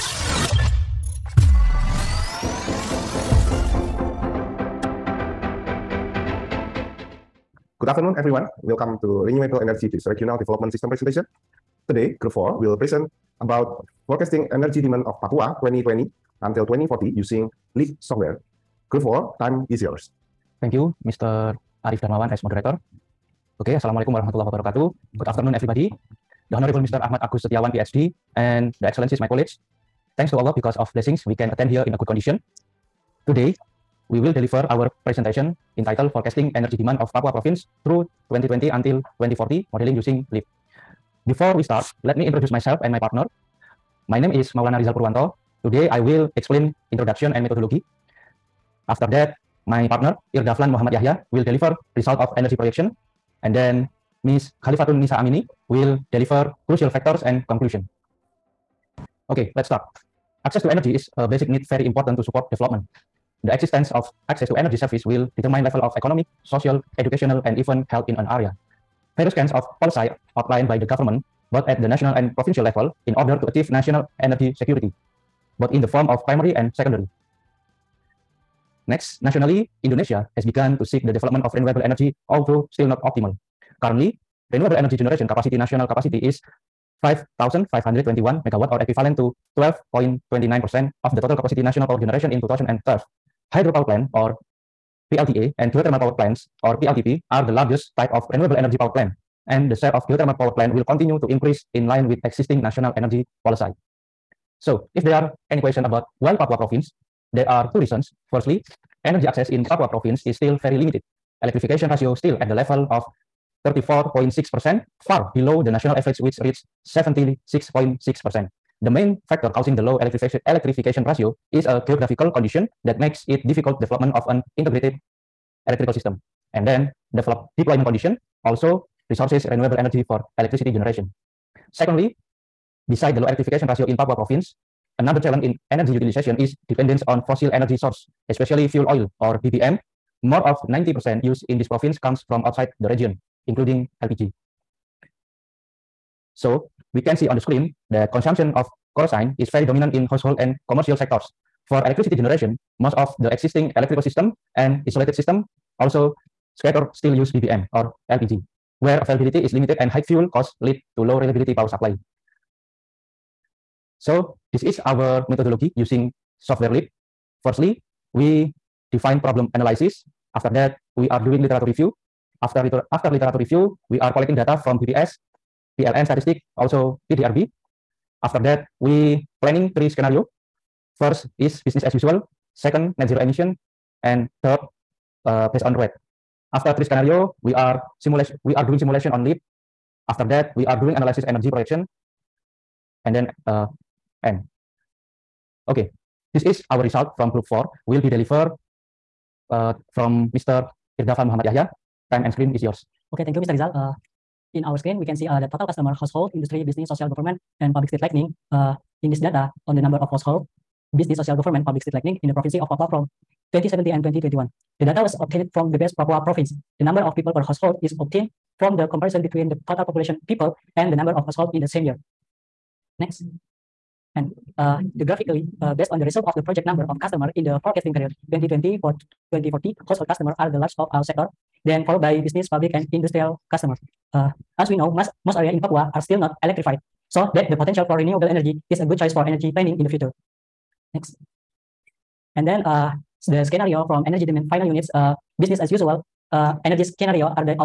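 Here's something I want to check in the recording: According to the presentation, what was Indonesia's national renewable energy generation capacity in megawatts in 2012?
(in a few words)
5,521 megawatt.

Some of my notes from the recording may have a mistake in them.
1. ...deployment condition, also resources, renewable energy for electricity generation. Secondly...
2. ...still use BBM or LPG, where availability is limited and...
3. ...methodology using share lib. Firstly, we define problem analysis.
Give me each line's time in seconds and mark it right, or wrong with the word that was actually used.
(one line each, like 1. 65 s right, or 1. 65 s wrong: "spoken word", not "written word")
1. 127 s right
2. 156 s right
3. 165 s wrong: "software", not "share".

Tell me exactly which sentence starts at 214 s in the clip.
The data was obtained from the best Papua province.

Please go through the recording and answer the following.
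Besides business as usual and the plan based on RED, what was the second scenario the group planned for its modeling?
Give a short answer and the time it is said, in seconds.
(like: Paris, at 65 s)
net zero emission, at 182 s.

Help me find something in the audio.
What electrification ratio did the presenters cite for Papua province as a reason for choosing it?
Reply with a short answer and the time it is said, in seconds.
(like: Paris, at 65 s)
34.6%, at 113 s.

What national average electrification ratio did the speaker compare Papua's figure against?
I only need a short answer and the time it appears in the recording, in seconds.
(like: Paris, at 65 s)
76.6%, at 116 s.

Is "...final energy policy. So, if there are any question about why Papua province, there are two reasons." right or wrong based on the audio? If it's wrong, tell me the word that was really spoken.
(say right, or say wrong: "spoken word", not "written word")
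wrong: "national", not "final".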